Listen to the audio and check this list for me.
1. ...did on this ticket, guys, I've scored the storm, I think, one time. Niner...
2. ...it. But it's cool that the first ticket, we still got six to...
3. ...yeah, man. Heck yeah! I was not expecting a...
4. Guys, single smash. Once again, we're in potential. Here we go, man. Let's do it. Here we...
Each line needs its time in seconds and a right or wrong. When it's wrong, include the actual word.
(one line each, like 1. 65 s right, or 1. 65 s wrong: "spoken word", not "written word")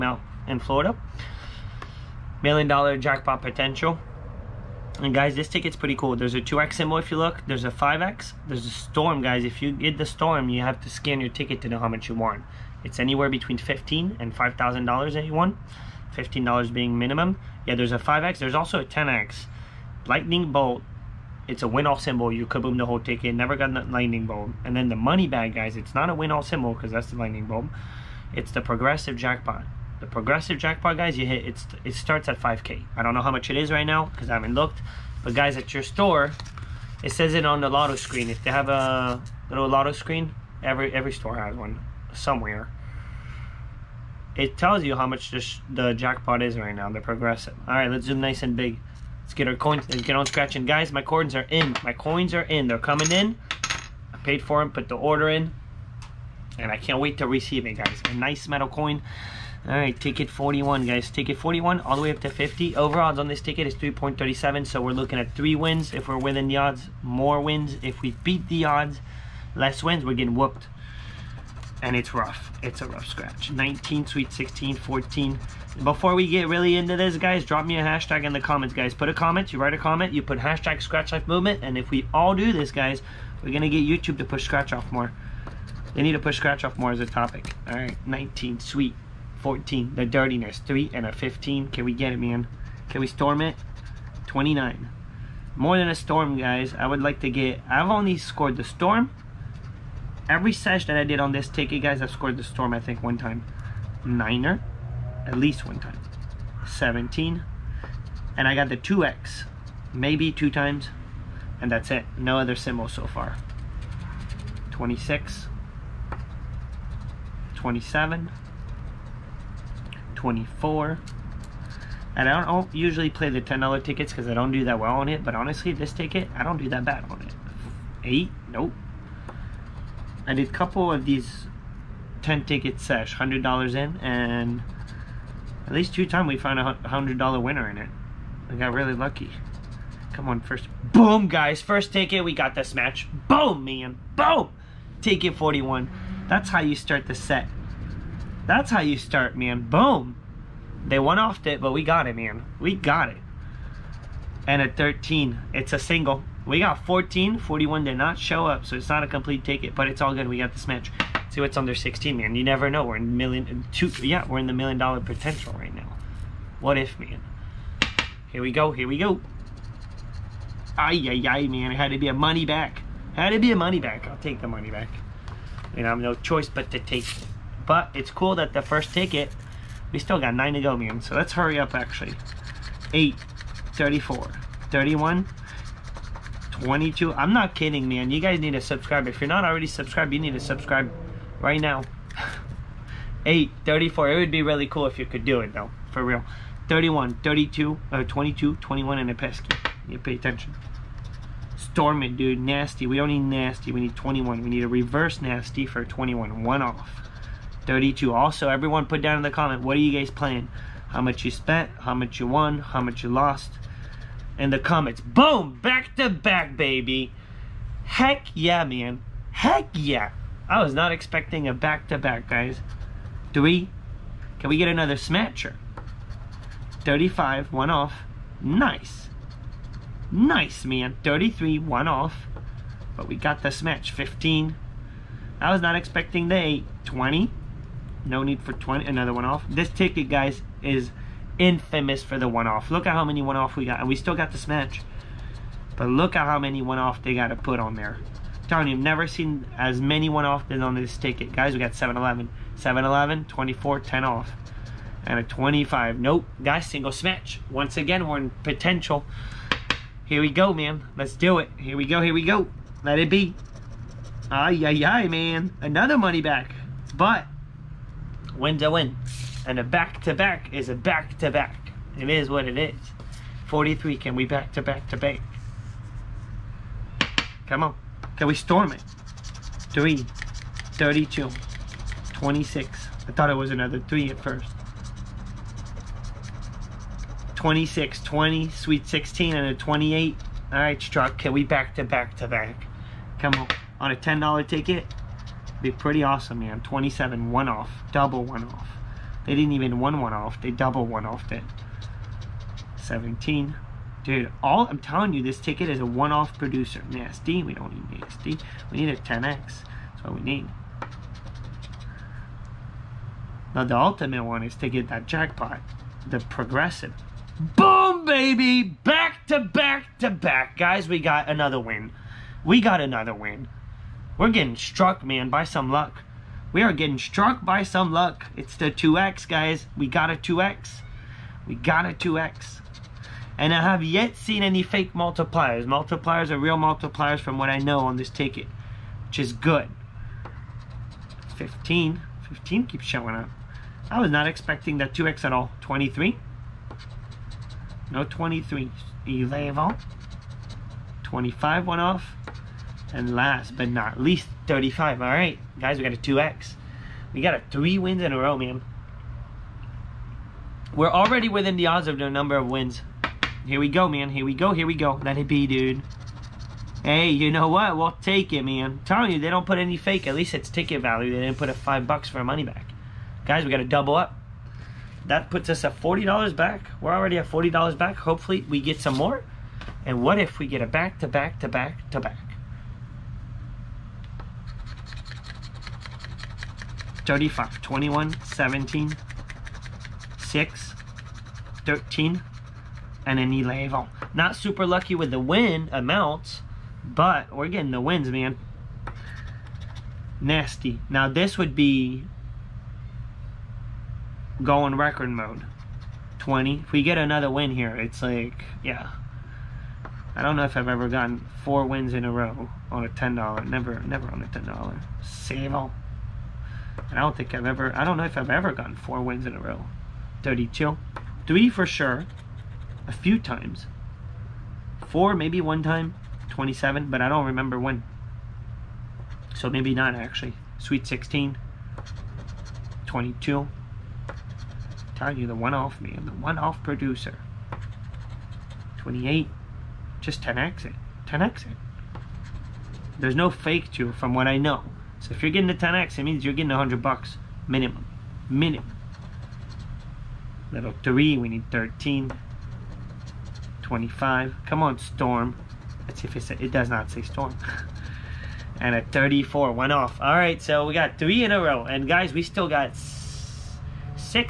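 1. 101 s right
2. 177 s wrong: "nine", not "six"
3. 218 s right
4. 256 s right.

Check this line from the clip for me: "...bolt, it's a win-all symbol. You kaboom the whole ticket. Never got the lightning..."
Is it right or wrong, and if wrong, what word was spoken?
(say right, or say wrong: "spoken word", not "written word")
right.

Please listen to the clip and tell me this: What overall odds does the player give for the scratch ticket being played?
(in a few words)
3.37.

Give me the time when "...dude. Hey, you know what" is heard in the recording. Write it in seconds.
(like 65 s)
365 s.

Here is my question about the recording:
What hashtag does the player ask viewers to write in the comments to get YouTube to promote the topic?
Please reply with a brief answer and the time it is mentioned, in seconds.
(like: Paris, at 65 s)
Scratch Life Movement, at 80 s.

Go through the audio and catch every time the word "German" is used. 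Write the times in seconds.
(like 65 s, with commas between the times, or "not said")
not said.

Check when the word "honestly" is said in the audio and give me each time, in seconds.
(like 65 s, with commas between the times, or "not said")
125 s.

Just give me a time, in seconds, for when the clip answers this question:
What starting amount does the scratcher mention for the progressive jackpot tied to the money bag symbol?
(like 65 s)
32 s.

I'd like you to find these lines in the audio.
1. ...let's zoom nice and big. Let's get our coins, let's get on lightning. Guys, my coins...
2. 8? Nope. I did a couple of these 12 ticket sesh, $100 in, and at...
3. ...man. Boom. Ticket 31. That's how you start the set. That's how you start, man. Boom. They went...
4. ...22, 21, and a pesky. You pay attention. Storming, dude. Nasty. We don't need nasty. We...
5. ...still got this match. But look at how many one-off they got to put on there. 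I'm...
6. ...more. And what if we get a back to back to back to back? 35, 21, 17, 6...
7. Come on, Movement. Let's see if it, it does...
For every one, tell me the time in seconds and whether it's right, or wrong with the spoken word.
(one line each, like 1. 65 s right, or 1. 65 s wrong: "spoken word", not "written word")
1. 47 s wrong: "scratching", not "lightning"
2. 128 s wrong: "10", not "12"
3. 143 s wrong: "41", not "31"
4. 198 s right
5. 243 s right
6. 378 s right
7. 454 s wrong: "Storm", not "Movement".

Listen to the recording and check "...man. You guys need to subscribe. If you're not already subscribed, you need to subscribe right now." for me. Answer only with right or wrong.
right.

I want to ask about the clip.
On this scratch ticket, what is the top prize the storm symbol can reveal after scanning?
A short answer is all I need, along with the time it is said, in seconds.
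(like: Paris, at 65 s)
$5,000, at 14 s.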